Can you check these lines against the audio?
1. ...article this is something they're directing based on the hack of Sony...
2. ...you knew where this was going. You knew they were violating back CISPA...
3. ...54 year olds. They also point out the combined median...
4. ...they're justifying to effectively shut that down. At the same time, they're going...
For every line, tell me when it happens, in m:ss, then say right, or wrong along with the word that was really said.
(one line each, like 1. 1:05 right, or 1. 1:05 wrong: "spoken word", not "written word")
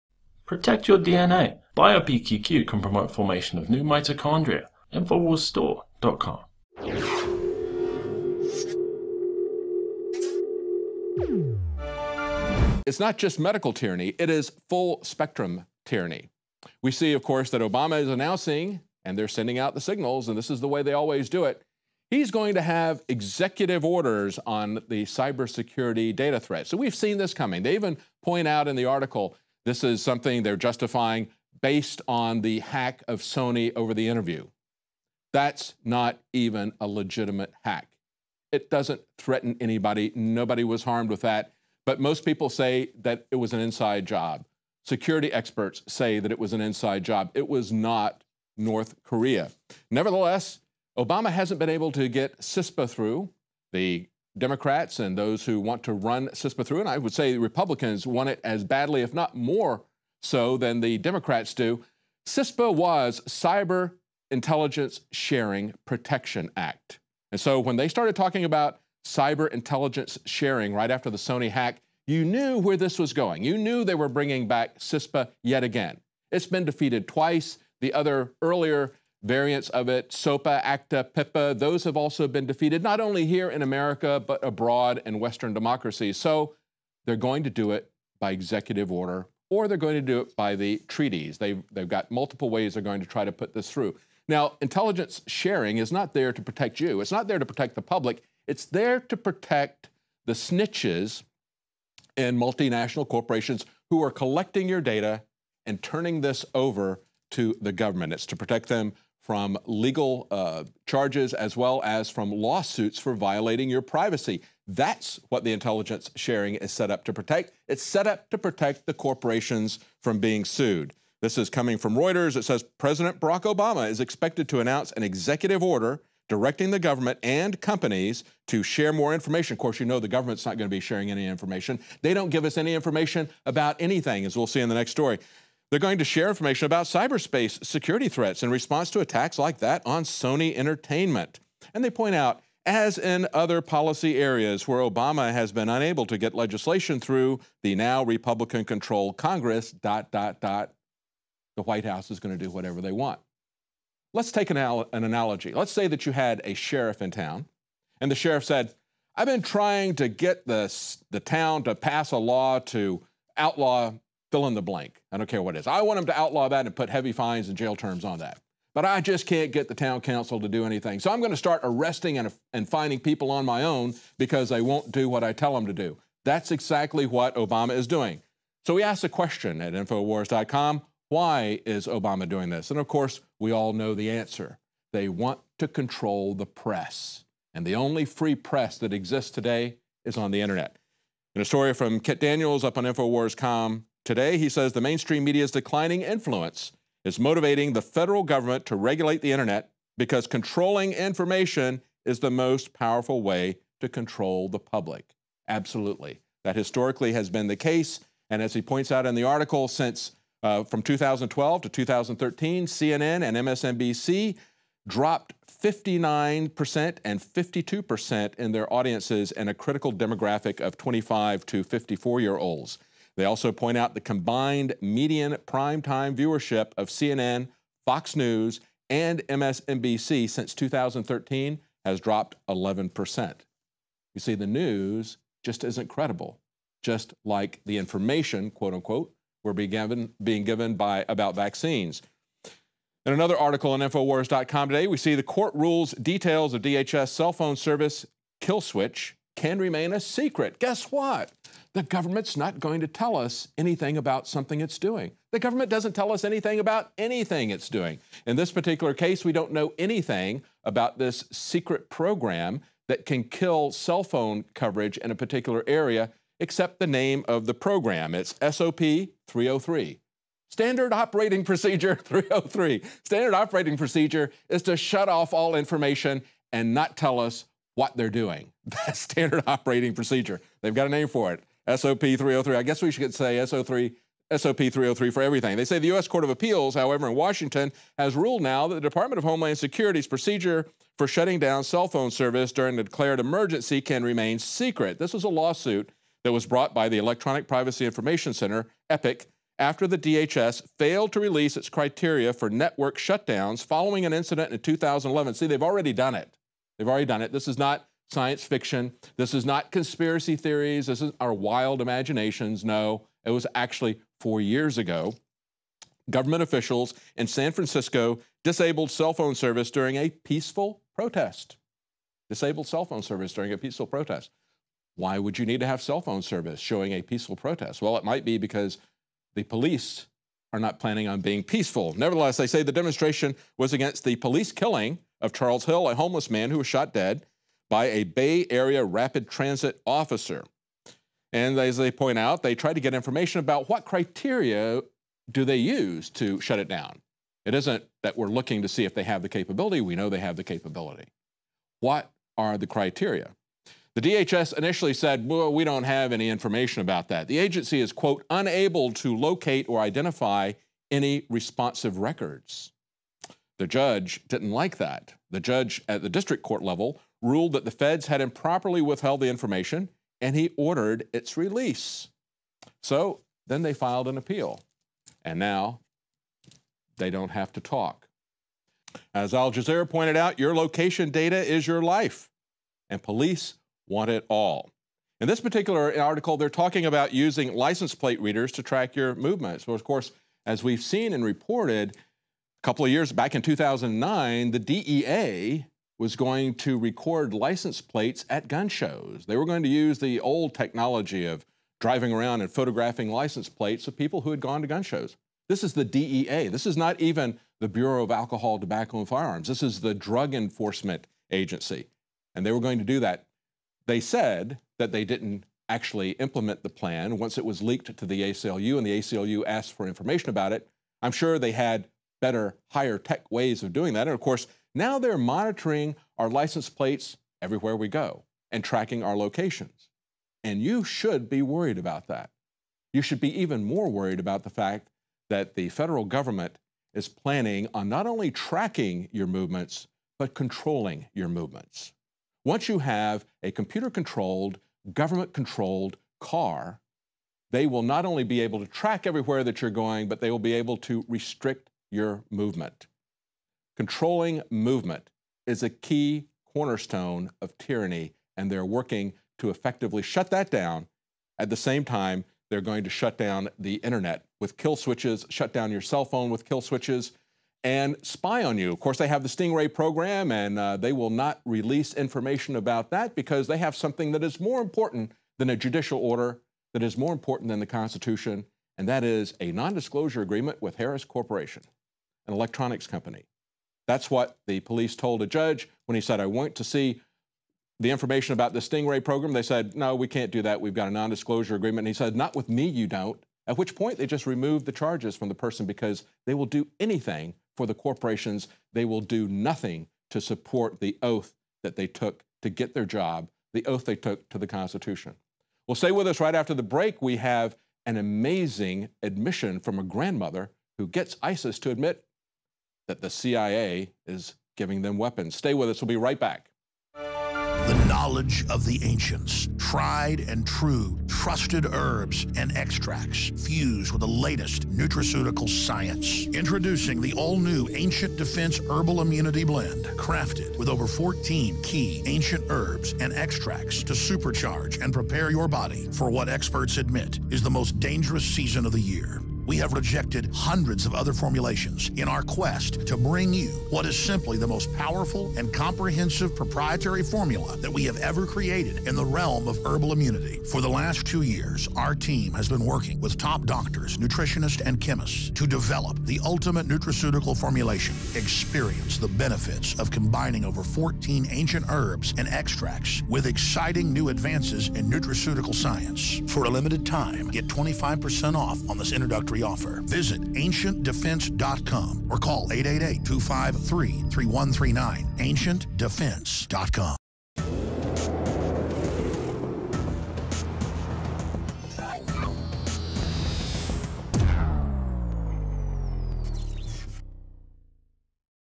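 1. 0:28 wrong: "justifying", not "directing"
2. 1:12 wrong: "bringing", not "violating"
3. 3:41 right
4. 7:38 wrong: "working", not "justifying".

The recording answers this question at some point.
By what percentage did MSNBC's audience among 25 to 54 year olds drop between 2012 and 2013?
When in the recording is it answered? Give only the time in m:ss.
3:37.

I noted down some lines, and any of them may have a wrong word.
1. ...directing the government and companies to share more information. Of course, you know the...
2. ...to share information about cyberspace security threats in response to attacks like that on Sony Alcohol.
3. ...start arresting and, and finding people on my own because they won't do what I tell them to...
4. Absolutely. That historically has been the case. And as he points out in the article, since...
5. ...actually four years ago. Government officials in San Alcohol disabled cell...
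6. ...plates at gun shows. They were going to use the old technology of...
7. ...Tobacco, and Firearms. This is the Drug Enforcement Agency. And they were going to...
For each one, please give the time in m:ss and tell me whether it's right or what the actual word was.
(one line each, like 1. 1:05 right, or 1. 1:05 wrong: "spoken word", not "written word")
1. 2:06 right
2. 2:15 wrong: "Entertainment", not "Alcohol"
3. 2:51 right
4. 3:25 right
5. 5:13 wrong: "Francisco", not "Alcohol"
6. 6:37 right
7. 6:48 right.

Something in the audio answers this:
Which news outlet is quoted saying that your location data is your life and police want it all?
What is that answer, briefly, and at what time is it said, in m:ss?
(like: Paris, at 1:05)
Al Jazeera, at 6:19.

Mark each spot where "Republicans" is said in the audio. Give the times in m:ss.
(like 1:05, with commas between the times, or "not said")
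0:57, 2:28.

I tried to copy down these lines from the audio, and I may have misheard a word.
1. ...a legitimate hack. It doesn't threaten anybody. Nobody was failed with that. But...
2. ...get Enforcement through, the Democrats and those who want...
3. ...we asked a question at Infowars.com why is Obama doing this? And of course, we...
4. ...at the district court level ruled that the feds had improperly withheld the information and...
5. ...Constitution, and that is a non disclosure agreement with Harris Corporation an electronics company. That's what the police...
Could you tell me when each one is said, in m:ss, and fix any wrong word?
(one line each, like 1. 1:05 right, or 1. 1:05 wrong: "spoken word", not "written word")
1. 0:36 wrong: "harmed", not "failed"
2. 0:52 wrong: "CISPA", not "Enforcement"
3. 2:58 right
4. 6:05 right
5. 7:57 right.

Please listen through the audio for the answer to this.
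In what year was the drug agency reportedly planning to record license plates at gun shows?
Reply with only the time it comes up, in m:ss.
6:33.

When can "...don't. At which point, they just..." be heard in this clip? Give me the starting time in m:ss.
8:12.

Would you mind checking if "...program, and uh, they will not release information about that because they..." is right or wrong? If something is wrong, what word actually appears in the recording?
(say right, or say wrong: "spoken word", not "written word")
right.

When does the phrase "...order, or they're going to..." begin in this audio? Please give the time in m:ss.
1:28.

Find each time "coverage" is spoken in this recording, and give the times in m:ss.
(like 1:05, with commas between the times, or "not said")
4:24.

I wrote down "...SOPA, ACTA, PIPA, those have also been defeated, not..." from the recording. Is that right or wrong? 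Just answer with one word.
right.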